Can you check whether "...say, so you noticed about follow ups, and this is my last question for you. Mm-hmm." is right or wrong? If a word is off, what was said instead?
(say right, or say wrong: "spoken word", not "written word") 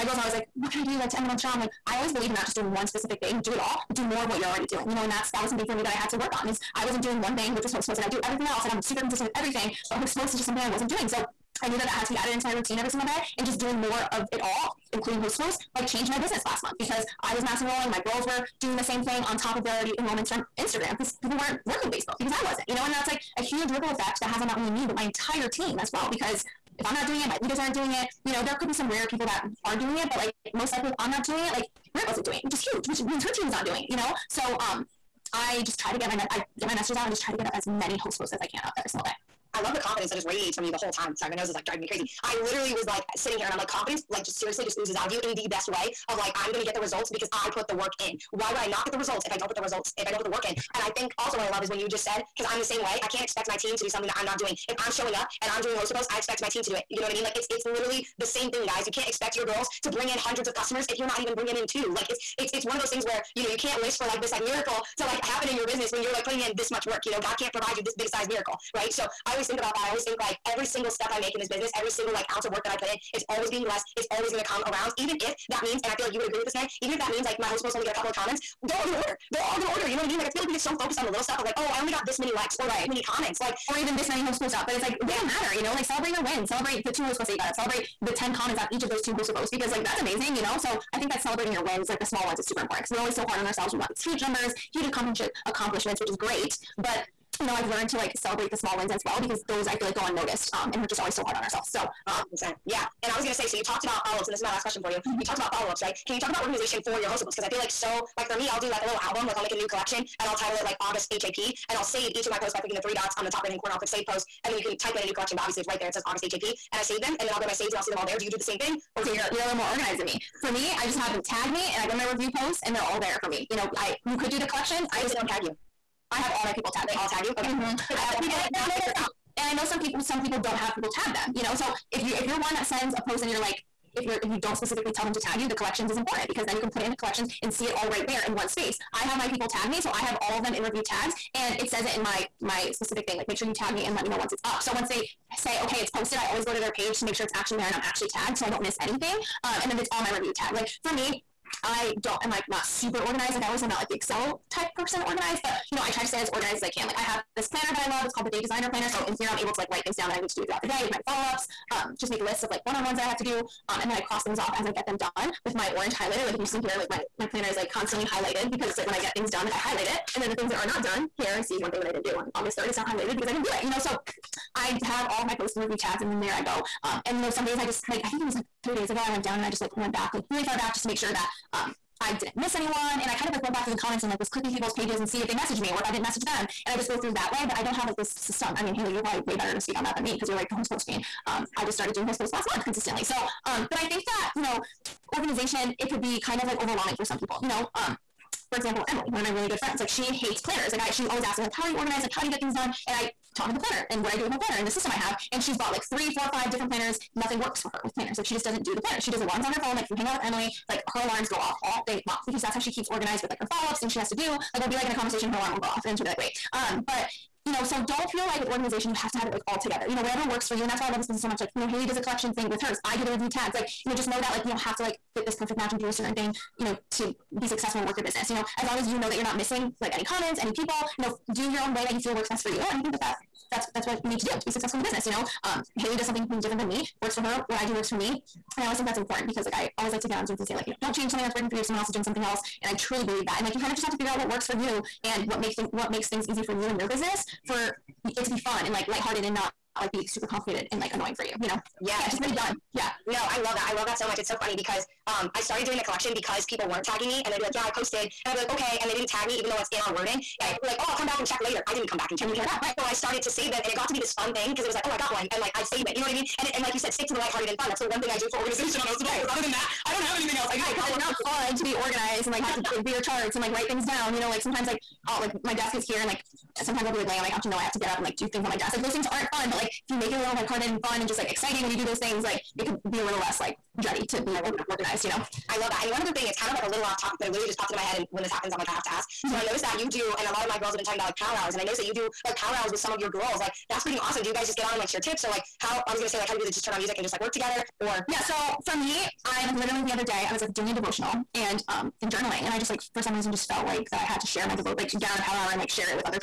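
wrong: "talked", not "noticed".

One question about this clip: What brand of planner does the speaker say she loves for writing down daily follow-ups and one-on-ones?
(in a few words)
Day Designer Planner.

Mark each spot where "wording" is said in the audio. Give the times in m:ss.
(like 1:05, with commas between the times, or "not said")
4:19.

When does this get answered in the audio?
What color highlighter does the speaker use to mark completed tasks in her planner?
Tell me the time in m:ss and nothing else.
2:45.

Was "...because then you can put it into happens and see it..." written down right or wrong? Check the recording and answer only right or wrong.
wrong.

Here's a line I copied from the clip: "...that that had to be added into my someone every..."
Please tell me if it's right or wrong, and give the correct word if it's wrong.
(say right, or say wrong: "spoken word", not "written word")
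wrong: "routine", not "someone".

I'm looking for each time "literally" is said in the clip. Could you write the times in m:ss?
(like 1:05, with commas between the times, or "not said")
0:42, 0:57, 4:47, 4:59.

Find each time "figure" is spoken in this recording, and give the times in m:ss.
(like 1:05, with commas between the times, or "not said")
4:03.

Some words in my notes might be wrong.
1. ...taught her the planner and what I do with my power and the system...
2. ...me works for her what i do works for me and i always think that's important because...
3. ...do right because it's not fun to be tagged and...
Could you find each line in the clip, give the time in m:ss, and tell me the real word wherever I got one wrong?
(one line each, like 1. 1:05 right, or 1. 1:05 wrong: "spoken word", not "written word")
1. 3:23 wrong: "planner", not "power"
2. 3:56 right
3. 4:30 wrong: "organized", not "tagged".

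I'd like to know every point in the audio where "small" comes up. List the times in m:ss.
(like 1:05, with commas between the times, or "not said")
1:32, 1:38.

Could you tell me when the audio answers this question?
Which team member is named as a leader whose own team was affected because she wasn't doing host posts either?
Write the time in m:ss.
0:31.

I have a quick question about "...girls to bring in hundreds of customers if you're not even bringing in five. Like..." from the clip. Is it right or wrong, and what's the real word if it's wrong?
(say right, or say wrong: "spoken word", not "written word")
wrong: "two", not "five".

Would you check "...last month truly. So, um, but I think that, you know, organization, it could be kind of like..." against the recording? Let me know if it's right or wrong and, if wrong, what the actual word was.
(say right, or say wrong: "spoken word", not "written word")
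wrong: "consistently", not "truly".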